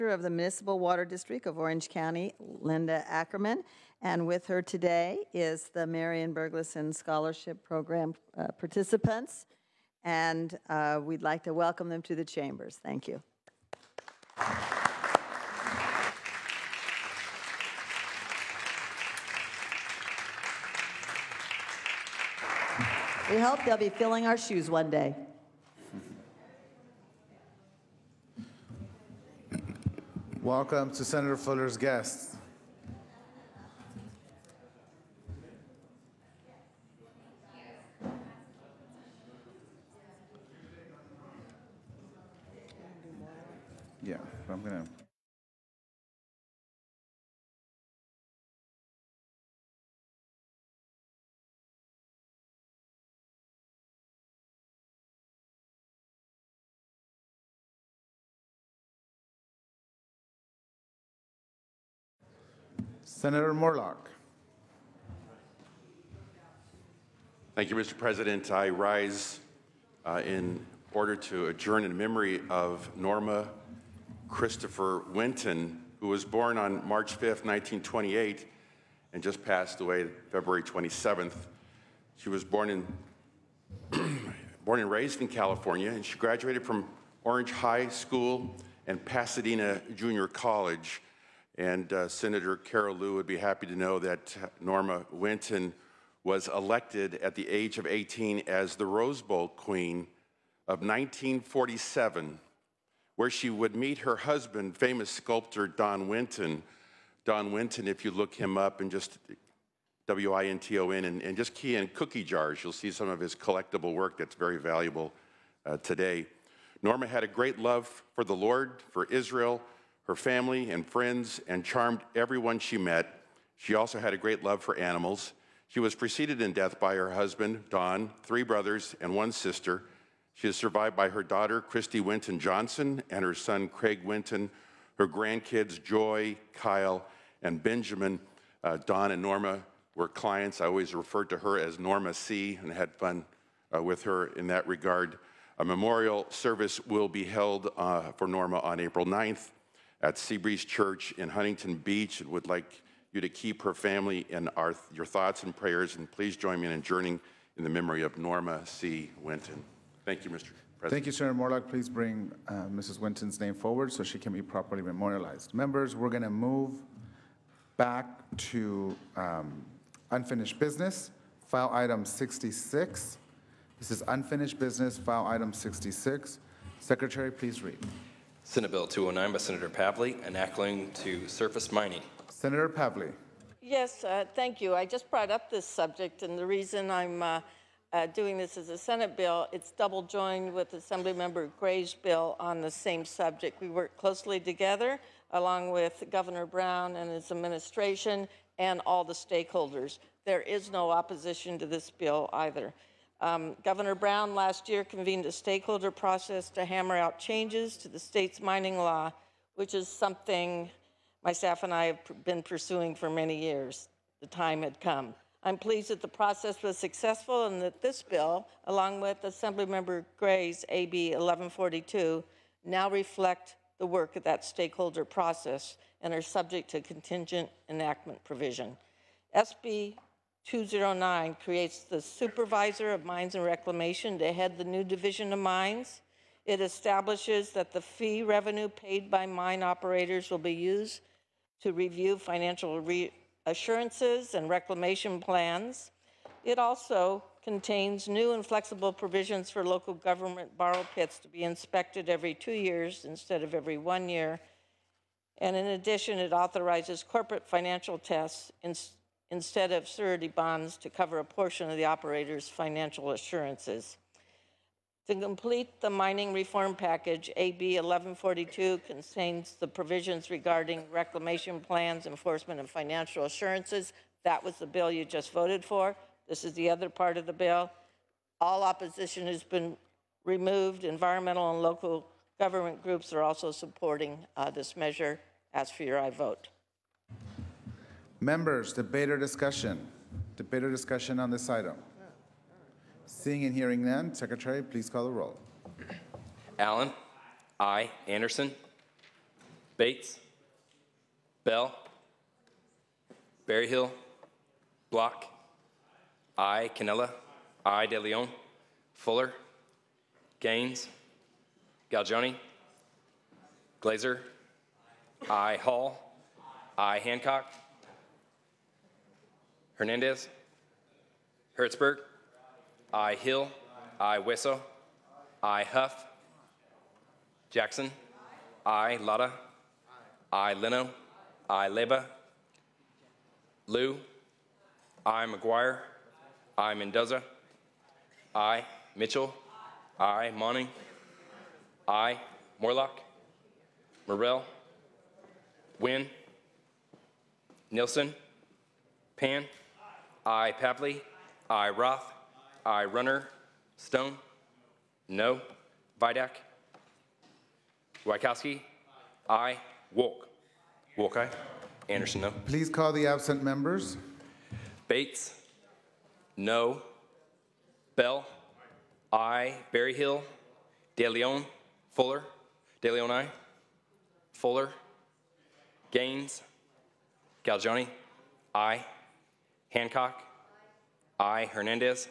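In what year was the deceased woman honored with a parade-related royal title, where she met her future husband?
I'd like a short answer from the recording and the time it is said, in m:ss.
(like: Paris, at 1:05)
1947, at 1:40.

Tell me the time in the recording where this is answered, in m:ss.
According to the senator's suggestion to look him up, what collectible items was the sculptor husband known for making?
1:51.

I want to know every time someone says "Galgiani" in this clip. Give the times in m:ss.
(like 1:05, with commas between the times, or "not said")
5:11, 6:17.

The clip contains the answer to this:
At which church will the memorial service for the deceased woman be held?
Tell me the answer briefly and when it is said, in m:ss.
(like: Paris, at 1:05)
Seabreeze Church, at 2:30.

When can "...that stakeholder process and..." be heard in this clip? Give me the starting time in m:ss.
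3:44.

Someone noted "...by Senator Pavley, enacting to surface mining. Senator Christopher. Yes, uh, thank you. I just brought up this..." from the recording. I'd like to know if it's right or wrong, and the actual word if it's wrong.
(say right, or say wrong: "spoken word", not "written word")
wrong: "Pavley", not "Christopher".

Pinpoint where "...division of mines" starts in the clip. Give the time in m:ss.
3:54.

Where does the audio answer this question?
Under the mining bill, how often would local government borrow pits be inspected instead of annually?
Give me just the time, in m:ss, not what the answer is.
4:12.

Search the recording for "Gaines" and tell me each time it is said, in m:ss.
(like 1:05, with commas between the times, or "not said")
5:10, 6:15.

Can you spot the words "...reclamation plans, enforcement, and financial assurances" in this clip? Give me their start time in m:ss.
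4:30.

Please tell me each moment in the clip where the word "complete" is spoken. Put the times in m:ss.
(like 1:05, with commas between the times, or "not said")
4:25.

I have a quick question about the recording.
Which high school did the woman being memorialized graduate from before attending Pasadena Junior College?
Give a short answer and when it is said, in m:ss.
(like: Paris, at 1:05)
Orange High School, at 1:27.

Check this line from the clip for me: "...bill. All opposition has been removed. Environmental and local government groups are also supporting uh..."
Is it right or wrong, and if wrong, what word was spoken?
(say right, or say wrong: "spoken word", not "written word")
right.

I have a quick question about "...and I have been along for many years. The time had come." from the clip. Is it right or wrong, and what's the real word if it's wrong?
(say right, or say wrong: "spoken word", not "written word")
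wrong: "pursuing", not "along".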